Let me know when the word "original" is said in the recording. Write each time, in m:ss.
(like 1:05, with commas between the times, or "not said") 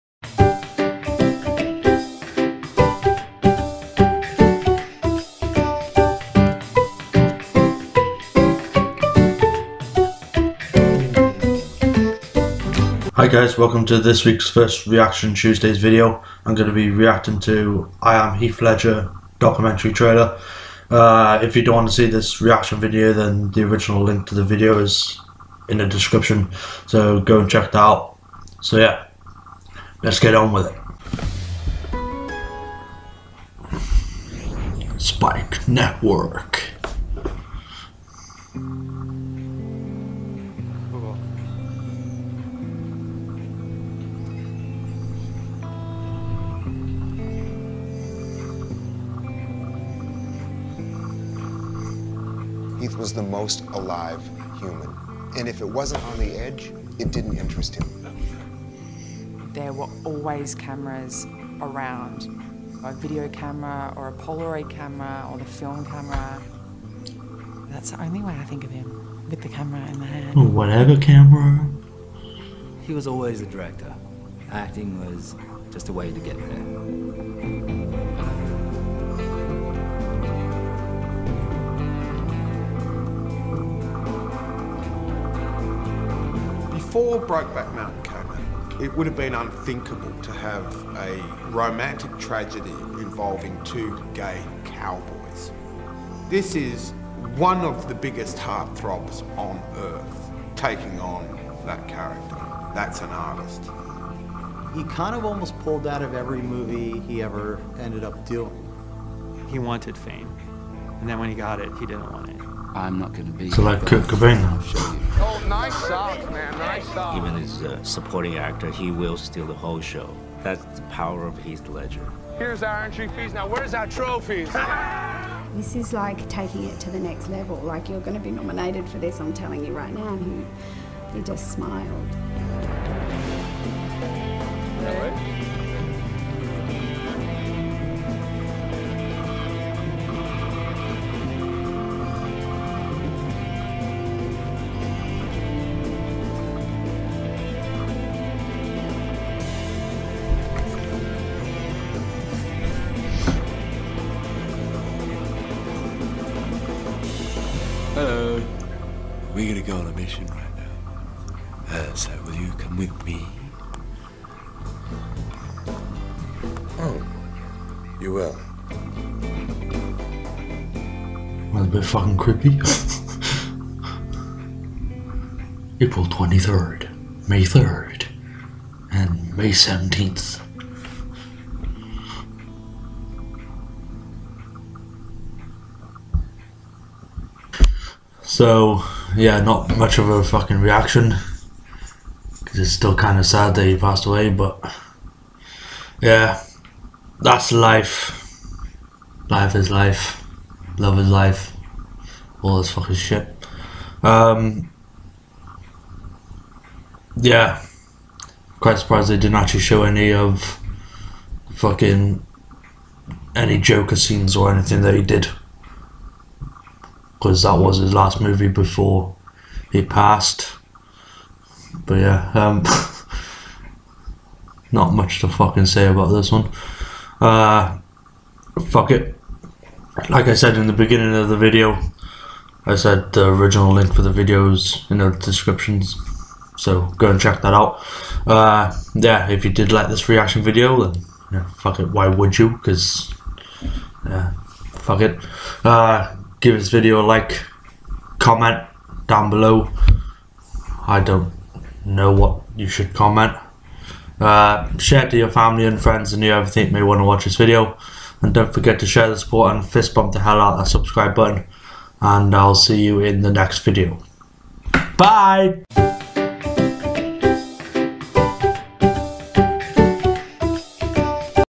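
0:23, 3:53.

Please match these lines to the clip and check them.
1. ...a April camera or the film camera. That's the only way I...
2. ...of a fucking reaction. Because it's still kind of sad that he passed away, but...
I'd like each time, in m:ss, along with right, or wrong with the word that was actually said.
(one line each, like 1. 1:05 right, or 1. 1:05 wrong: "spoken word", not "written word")
1. 1:04 wrong: "Polaroid", not "April"
2. 3:09 right.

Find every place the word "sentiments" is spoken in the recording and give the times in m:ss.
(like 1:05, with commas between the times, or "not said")
not said.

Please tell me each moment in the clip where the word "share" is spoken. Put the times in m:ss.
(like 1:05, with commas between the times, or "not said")
4:14, 4:18.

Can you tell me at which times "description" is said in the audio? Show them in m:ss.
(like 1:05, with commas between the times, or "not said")
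0:25, 3:55.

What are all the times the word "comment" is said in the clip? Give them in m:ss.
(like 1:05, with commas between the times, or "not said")
4:08, 4:12.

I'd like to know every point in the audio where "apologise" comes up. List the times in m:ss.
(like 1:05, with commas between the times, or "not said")
not said.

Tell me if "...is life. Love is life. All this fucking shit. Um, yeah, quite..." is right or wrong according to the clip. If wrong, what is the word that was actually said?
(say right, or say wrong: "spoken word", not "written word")
right.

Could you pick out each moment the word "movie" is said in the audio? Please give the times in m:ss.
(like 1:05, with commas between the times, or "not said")
1:46, 3:38.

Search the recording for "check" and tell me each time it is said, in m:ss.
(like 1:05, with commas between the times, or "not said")
0:27, 3:57.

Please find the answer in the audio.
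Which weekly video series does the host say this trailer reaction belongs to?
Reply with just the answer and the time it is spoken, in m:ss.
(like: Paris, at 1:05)
Reaction Tuesdays, at 0:14.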